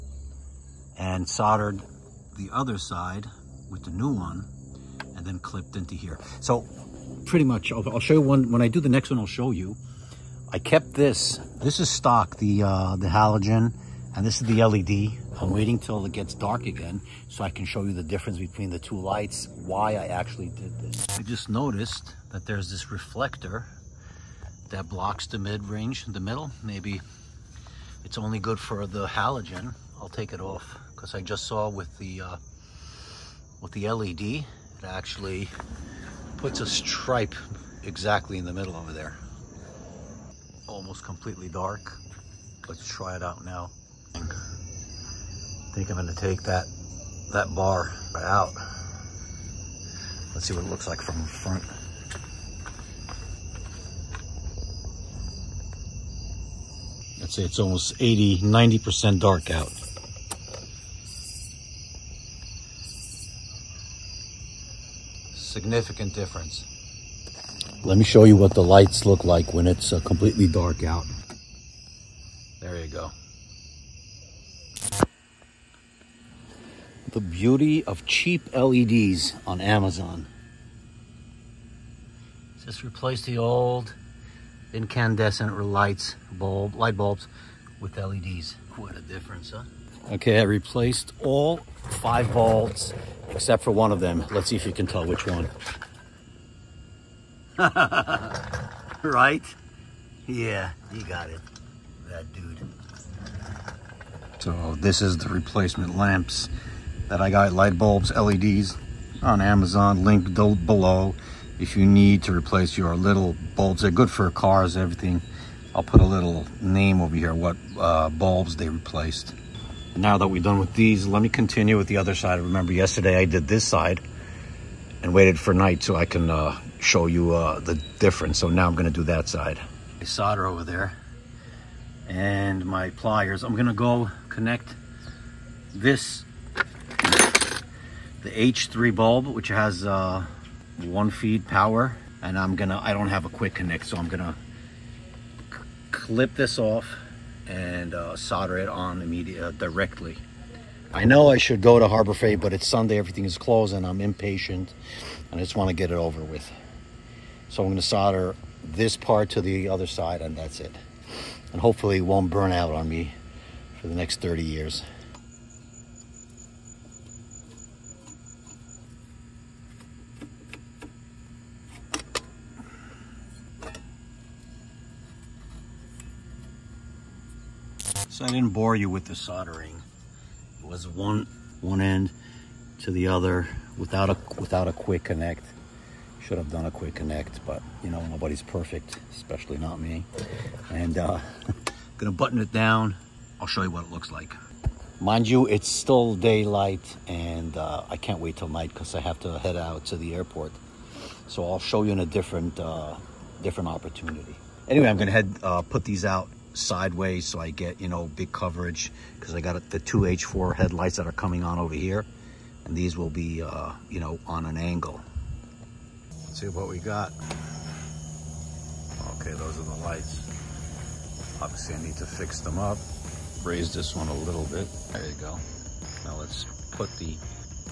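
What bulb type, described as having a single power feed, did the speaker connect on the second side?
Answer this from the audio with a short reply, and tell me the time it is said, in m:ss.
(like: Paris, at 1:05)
H3, at 2:18.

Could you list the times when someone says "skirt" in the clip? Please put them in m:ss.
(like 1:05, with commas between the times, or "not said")
not said.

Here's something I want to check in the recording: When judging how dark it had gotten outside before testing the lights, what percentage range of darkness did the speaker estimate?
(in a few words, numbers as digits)
80-90%.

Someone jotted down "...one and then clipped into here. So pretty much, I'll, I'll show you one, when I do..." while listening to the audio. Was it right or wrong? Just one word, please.
right.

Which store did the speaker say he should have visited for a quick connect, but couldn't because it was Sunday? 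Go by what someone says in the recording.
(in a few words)
Harbor Freight.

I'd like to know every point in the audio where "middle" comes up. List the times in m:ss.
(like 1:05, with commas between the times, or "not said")
0:26, 0:38.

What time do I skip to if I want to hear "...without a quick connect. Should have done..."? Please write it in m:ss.
3:04.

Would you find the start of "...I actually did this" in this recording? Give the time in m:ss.
0:19.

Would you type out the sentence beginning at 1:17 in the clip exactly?
the beauty of cheap LEDs on Amazon.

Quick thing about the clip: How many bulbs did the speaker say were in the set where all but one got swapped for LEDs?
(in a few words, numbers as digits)
5.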